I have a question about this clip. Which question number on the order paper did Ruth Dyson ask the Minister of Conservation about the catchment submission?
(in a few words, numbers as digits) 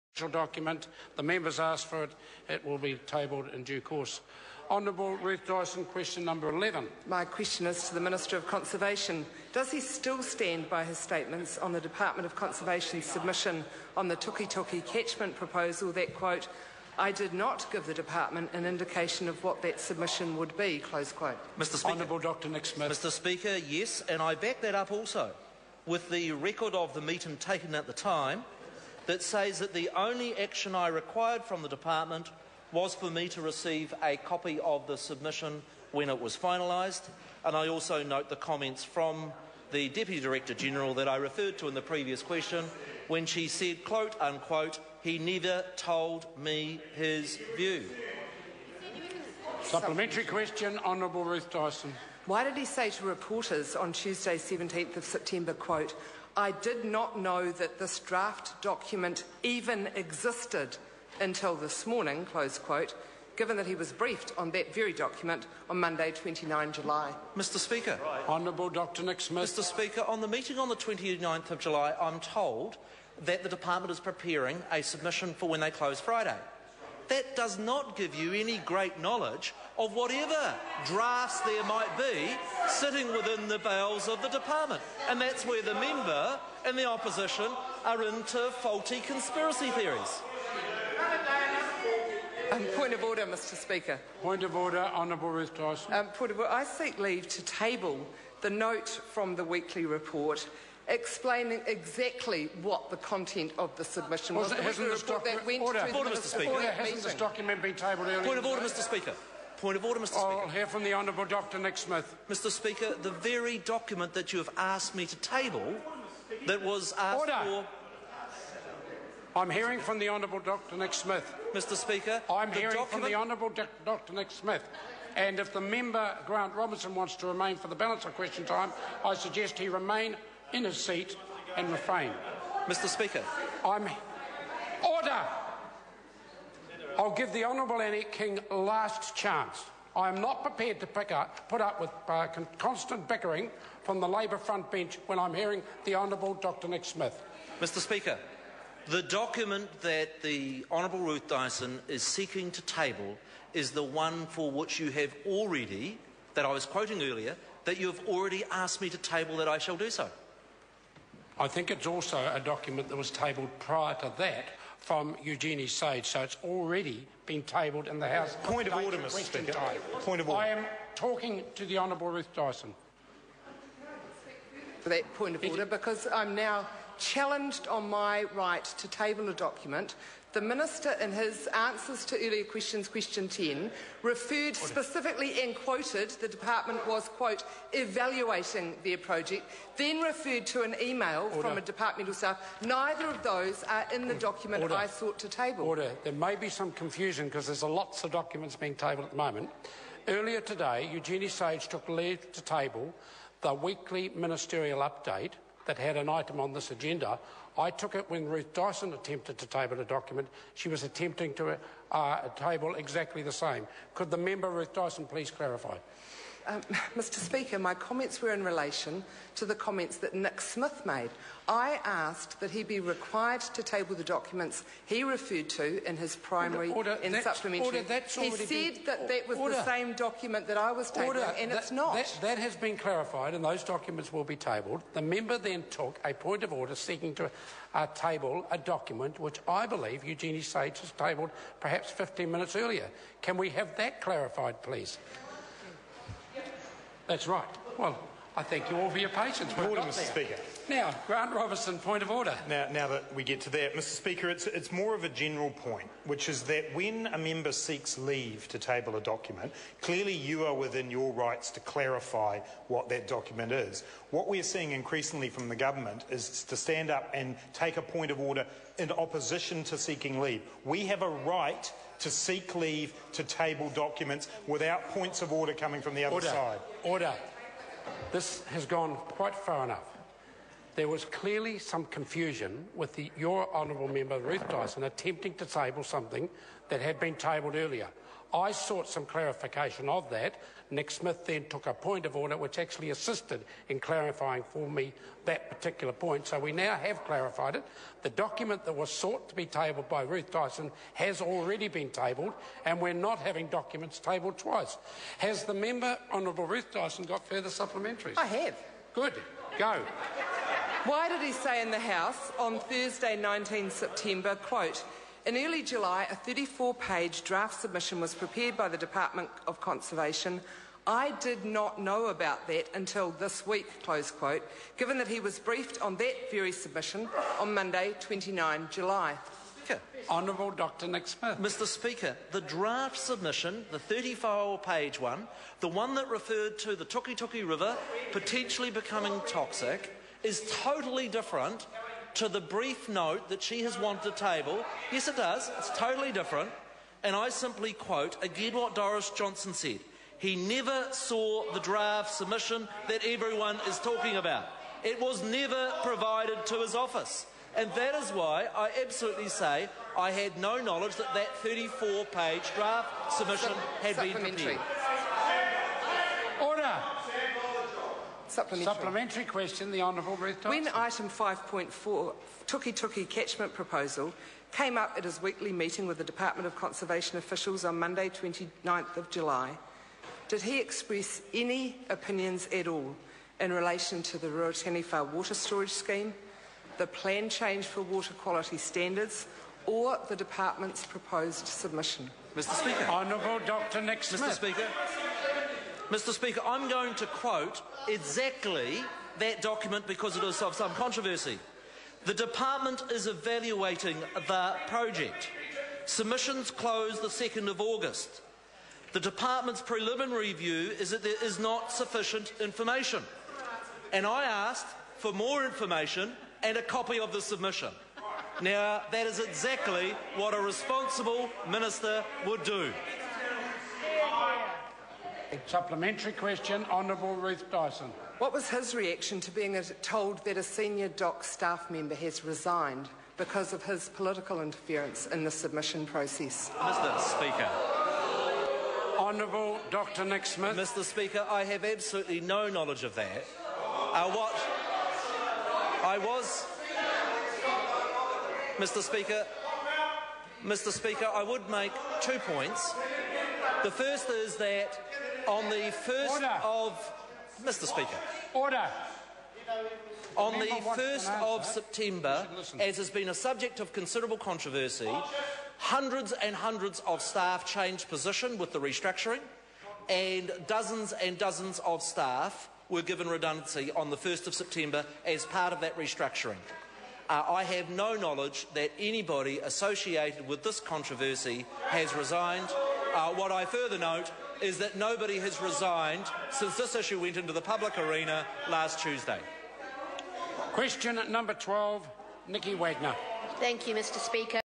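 11.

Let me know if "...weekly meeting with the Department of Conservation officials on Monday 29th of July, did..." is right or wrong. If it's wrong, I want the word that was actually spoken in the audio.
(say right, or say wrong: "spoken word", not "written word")
right.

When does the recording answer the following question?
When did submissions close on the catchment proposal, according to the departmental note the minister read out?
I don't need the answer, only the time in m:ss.
6:47.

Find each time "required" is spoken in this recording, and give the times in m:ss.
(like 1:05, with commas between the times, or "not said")
0:30, 3:42.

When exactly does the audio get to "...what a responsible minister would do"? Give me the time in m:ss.
7:00.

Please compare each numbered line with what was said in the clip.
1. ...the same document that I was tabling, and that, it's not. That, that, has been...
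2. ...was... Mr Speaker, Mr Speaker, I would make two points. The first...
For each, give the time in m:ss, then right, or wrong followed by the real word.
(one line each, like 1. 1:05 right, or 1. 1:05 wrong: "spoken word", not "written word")
1. 3:49 right
2. 7:25 right.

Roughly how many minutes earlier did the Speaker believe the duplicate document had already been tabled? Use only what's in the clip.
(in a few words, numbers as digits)
15.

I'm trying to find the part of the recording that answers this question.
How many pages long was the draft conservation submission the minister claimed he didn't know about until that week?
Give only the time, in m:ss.
5:16.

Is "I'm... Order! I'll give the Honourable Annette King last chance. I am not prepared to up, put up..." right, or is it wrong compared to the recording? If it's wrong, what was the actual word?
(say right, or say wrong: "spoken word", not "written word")
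right.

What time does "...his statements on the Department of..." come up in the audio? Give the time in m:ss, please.
0:10.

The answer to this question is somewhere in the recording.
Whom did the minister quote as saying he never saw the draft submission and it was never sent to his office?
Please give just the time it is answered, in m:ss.
5:48.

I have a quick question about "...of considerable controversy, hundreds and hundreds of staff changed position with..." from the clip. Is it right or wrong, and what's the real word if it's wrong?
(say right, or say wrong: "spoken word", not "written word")
right.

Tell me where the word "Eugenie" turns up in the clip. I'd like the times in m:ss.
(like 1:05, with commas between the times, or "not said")
2:45, 3:20, 4:00.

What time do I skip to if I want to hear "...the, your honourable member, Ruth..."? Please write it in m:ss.
4:42.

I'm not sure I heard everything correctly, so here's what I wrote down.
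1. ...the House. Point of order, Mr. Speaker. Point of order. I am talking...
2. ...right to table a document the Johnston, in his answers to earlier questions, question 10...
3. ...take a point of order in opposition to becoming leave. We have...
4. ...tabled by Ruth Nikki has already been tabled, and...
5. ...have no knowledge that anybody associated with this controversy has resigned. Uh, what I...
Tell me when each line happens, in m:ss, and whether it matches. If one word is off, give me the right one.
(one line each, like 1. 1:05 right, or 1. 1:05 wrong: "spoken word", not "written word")
1. 2:47 right
2. 2:58 wrong: "Minister", not "Johnston"
3. 4:27 wrong: "seeking", not "becoming"
4. 4:59 wrong: "Dyson", not "Nikki"
5. 7:57 right.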